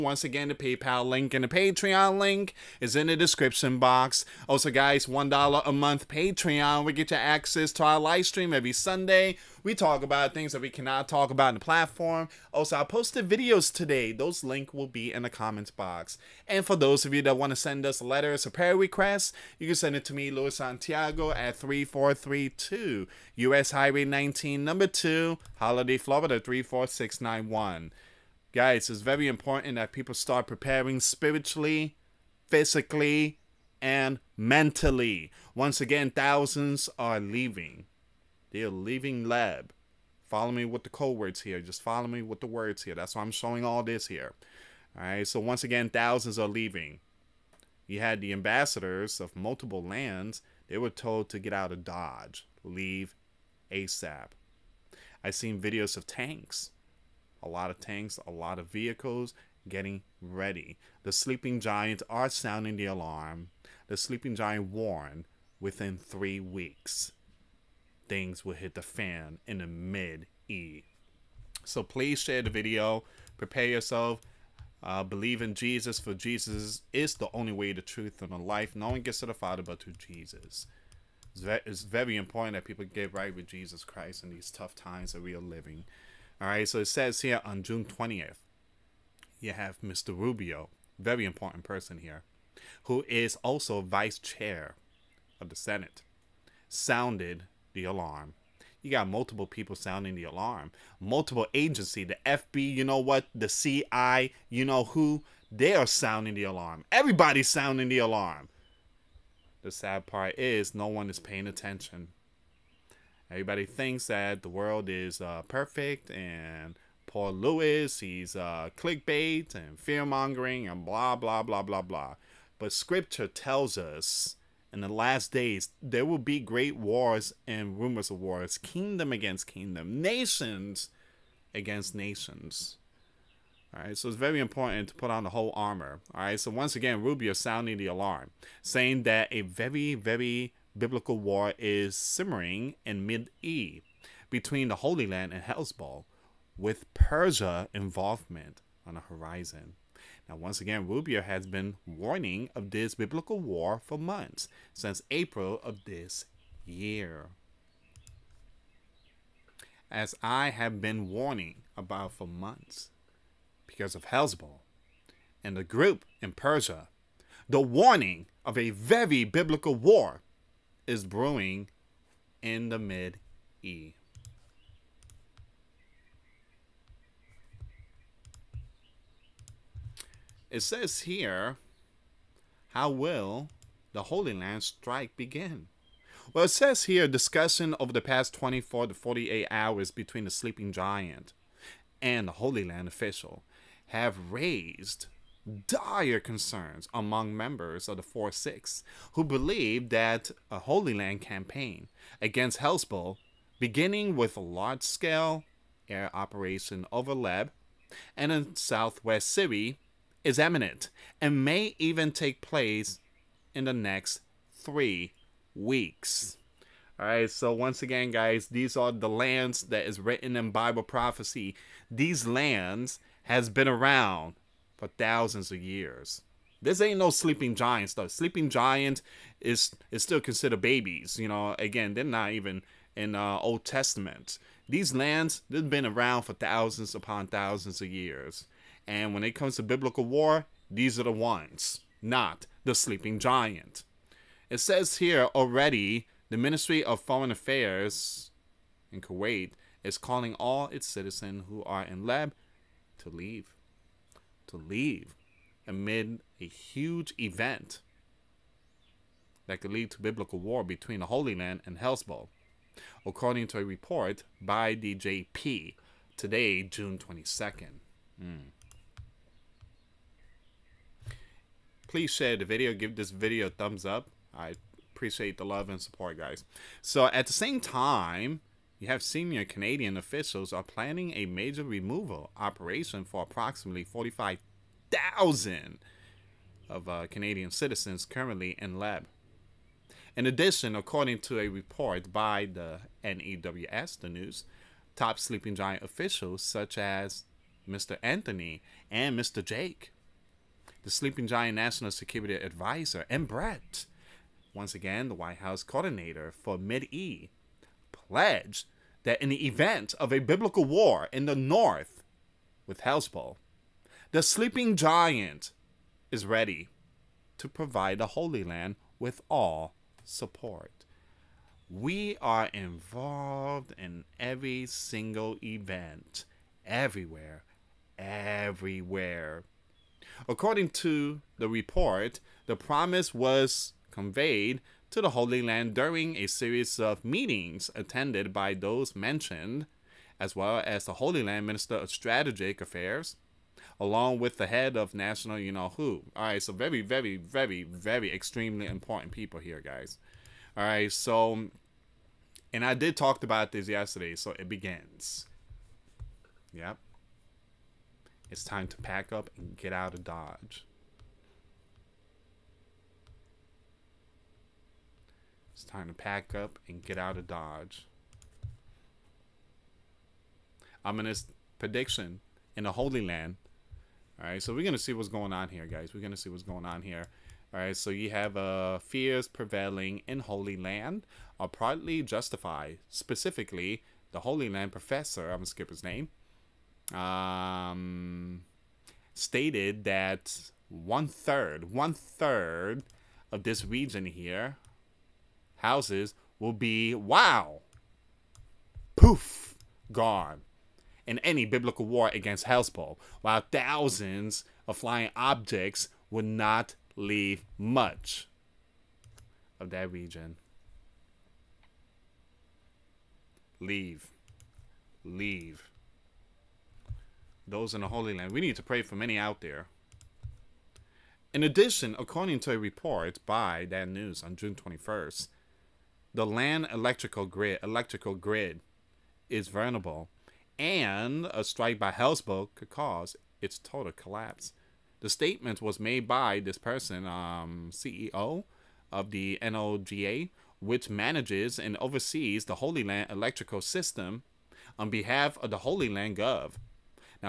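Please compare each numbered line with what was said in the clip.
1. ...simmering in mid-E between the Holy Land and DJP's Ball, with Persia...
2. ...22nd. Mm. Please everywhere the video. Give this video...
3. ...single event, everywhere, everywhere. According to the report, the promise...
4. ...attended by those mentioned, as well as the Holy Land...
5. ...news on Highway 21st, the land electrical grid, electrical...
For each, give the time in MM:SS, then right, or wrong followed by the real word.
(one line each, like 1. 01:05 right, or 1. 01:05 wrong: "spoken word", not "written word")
1. 02:21 wrong: "Hell", not "DJP"
2. 04:26 wrong: "share", not "everywhere"
3. 05:24 right
4. 05:37 right
5. 07:03 wrong: "June", not "Highway".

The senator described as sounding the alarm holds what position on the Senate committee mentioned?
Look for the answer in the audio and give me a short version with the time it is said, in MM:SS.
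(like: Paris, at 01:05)
vice chair, at 01:33.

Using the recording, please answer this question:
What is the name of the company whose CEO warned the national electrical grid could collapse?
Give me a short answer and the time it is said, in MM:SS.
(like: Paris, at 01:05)
NOGA, at 07:19.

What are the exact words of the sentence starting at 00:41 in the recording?
Just follow me with the words here.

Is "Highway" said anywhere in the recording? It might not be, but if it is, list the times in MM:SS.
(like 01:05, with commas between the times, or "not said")
00:23.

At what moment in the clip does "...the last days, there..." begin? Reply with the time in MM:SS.
02:04.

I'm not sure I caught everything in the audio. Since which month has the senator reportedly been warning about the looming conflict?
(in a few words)
April.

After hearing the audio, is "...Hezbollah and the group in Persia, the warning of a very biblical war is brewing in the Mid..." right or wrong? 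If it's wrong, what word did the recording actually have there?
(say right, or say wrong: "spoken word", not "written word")
right.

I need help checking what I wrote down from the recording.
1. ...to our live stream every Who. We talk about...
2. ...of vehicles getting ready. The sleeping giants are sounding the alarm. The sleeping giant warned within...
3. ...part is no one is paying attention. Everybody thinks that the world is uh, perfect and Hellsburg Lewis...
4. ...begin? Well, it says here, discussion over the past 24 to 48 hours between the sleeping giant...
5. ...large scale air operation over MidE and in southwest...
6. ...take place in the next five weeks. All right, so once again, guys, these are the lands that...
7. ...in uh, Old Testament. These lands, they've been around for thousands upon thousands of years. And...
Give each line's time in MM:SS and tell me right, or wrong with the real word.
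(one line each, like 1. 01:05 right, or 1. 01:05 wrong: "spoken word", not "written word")
1. 00:07 wrong: "Sunday", not "Who"
2. 00:58 right
3. 01:50 wrong: "Paul", not "Hellsburg"
4. 03:05 right
5. 03:24 wrong: "Leb", not "MidE"
6. 03:32 wrong: "three", not "five"
7. 03:52 right.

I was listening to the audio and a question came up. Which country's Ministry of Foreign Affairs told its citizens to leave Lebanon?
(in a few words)
Kuwait.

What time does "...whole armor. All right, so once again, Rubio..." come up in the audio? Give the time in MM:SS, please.
02:15.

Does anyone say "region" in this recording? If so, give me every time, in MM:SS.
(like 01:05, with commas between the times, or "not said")
06:33, 06:49.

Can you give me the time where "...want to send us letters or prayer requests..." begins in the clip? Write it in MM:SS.
00:17.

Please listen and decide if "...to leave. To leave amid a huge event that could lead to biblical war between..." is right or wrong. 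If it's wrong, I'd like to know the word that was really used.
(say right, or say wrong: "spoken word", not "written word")
right.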